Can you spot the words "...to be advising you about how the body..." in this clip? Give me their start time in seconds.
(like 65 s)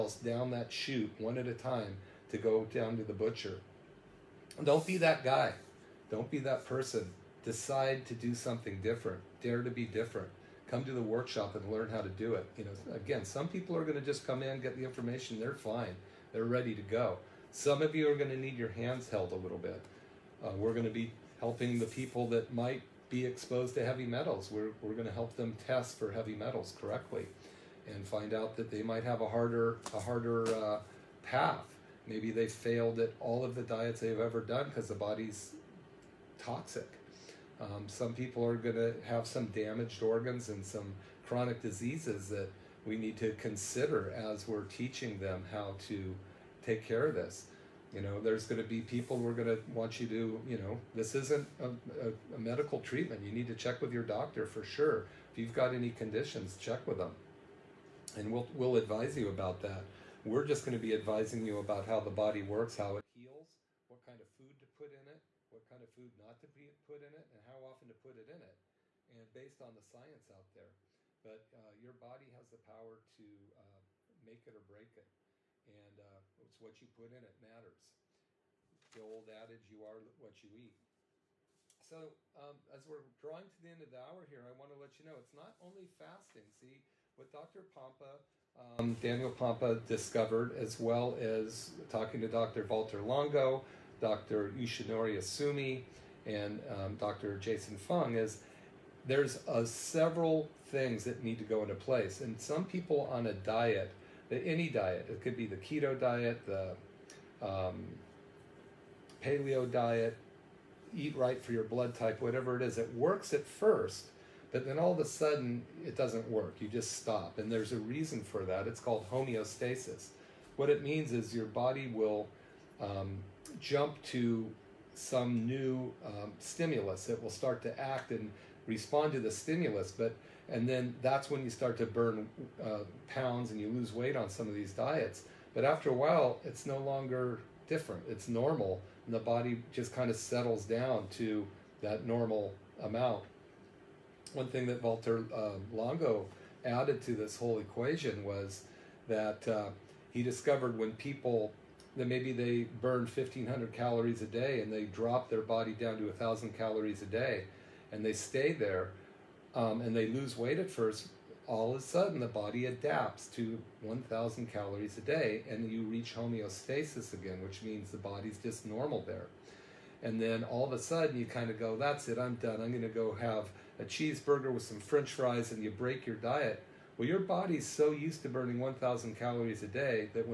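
60 s.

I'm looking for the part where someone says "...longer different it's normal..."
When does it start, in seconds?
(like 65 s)
136 s.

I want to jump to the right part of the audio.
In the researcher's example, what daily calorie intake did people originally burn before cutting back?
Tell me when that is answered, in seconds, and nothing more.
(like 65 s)
153 s.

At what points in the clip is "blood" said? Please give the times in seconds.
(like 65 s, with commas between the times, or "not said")
111 s.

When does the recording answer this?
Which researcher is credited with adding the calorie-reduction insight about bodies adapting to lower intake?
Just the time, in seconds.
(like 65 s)
144 s.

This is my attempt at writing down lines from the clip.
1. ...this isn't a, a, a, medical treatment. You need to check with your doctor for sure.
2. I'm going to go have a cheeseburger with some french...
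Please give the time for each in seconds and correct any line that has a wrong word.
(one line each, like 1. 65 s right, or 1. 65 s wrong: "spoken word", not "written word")
1. 50 s right
2. 172 s right.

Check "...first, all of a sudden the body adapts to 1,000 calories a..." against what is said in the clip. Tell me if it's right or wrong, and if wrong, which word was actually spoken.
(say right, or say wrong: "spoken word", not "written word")
right.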